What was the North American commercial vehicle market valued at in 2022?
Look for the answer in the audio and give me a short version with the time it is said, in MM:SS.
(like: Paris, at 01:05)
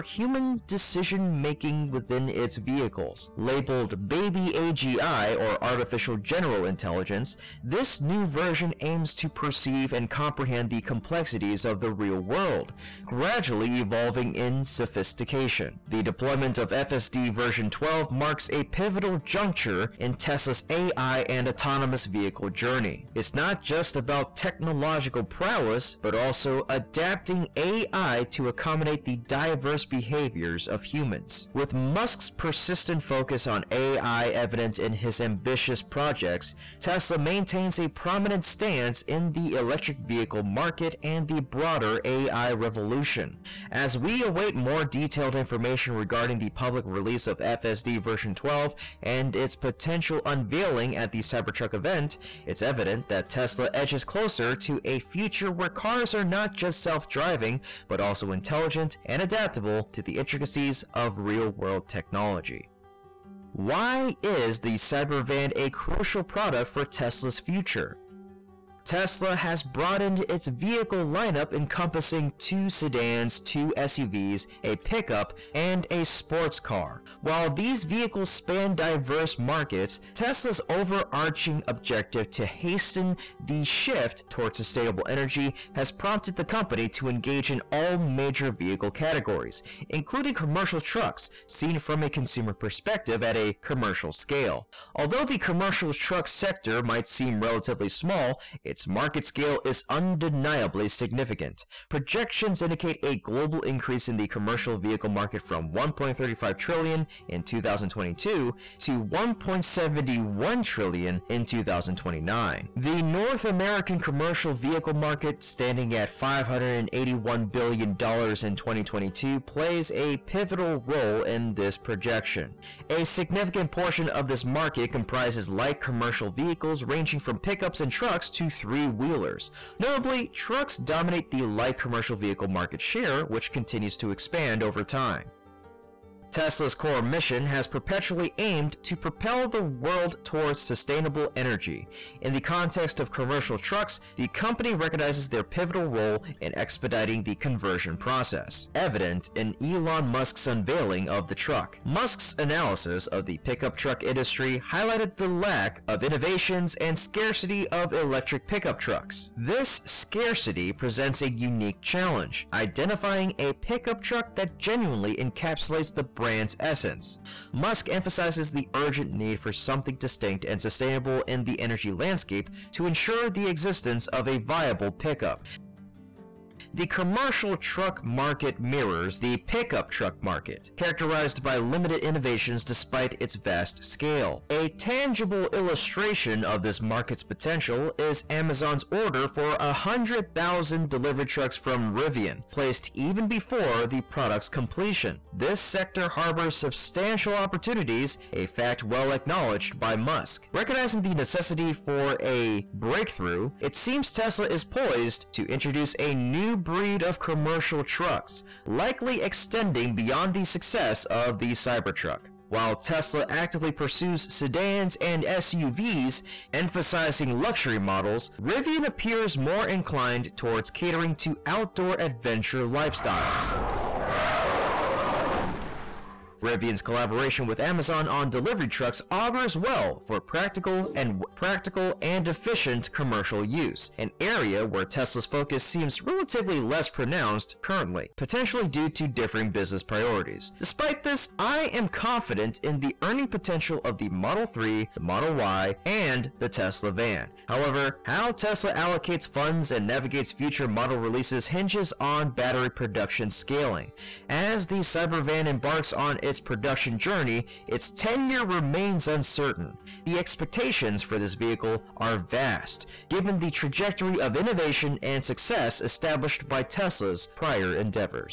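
581 billion dollars, at 01:56.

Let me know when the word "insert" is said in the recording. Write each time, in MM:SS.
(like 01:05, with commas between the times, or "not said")
not said.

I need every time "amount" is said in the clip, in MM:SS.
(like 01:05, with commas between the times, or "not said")
not said.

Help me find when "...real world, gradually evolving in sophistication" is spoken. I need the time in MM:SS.
00:11.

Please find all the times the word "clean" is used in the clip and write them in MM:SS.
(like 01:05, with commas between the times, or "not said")
not said.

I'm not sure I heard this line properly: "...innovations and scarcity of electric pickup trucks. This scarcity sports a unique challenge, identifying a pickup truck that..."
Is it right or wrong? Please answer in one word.
wrong.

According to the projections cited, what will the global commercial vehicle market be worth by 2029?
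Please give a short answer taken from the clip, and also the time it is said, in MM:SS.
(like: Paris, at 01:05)
1.71 trillion, at 01:49.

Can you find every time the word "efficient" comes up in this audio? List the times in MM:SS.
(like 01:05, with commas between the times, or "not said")
03:52.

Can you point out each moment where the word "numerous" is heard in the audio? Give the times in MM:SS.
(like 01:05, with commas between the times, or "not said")
not said.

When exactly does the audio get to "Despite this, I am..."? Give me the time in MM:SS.
04:00.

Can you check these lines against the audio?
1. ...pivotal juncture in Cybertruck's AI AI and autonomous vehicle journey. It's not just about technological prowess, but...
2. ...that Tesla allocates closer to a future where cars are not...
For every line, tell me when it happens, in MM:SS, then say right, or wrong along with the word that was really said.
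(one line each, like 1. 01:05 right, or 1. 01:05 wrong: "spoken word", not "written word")
1. 00:18 wrong: "Tesla", not "Cybertruck"
2. 00:53 wrong: "edges", not "allocates".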